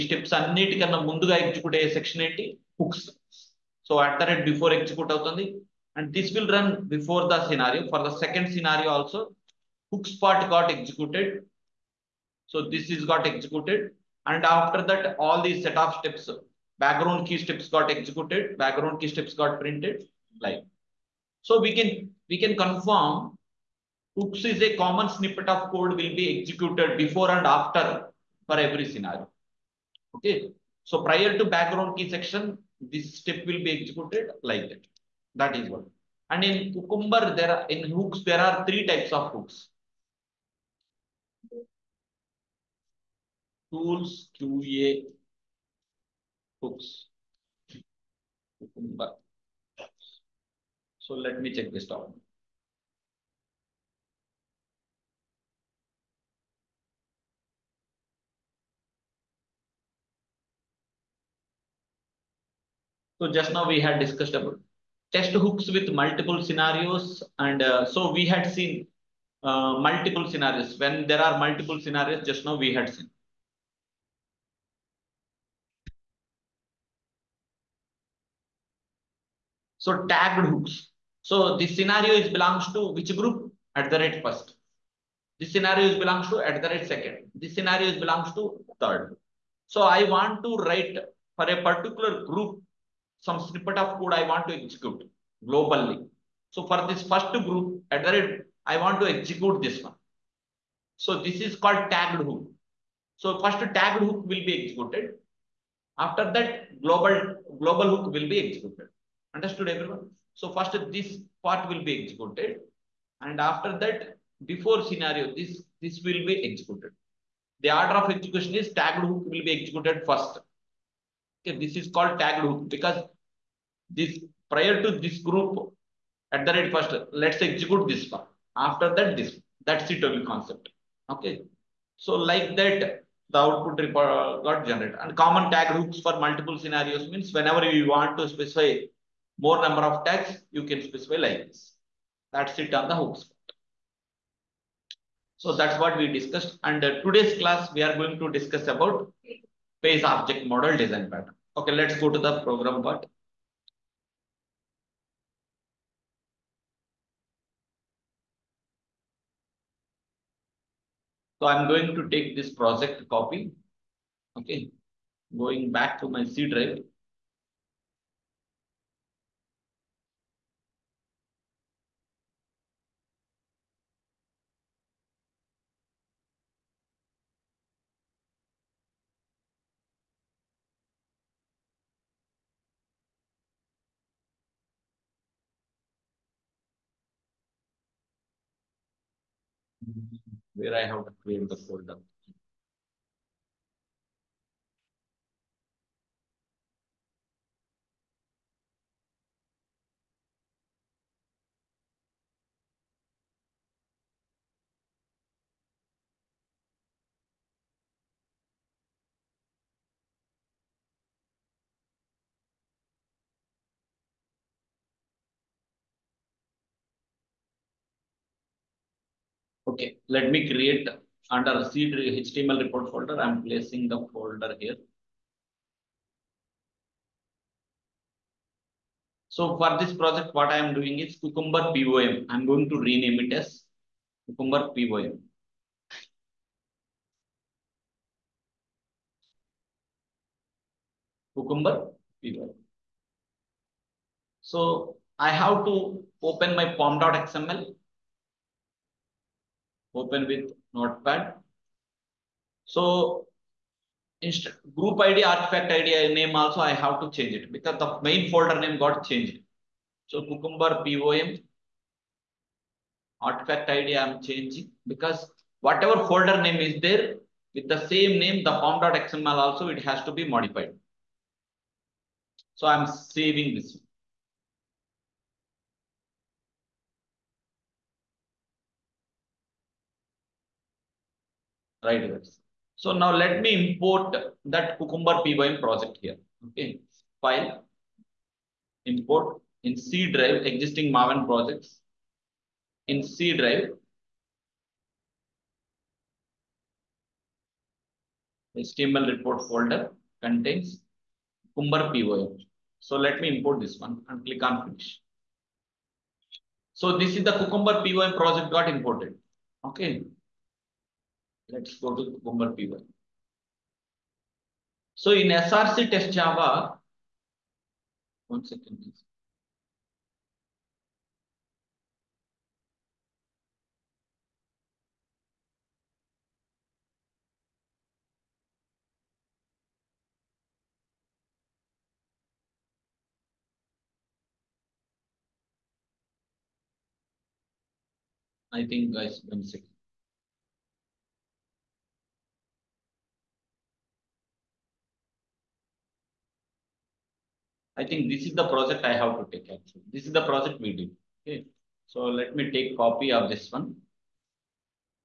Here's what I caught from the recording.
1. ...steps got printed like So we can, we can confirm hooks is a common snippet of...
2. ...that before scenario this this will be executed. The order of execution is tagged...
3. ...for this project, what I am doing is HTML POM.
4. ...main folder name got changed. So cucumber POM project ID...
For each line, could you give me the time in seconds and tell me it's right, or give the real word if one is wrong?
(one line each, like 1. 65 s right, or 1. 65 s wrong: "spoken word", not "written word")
1. 19 s right
2. 113 s right
3. 229 s wrong: "Cucumber", not "HTML"
4. 258 s wrong: "artifact", not "project".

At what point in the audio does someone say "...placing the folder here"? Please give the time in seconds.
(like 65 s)
223 s.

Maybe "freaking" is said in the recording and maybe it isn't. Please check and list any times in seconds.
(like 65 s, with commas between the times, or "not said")
not said.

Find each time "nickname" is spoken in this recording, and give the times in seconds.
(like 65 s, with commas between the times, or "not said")
not said.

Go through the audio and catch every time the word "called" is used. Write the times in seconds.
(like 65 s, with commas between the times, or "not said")
101 s, 121 s.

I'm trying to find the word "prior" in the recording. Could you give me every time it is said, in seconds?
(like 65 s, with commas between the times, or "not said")
31 s, 124 s.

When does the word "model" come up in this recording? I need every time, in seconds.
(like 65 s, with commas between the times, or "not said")
150 s.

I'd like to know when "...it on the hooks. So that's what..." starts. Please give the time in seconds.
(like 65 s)
142 s.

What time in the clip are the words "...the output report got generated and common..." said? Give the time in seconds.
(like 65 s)
133 s.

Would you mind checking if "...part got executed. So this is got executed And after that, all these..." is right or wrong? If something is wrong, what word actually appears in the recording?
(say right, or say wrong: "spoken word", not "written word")
right.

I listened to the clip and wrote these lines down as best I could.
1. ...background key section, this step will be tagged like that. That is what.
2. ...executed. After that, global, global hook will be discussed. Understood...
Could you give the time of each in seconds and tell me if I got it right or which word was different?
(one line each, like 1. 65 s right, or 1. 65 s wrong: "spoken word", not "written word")
1. 31 s wrong: "executed", not "tagged"
2. 104 s wrong: "executed", not "discussed".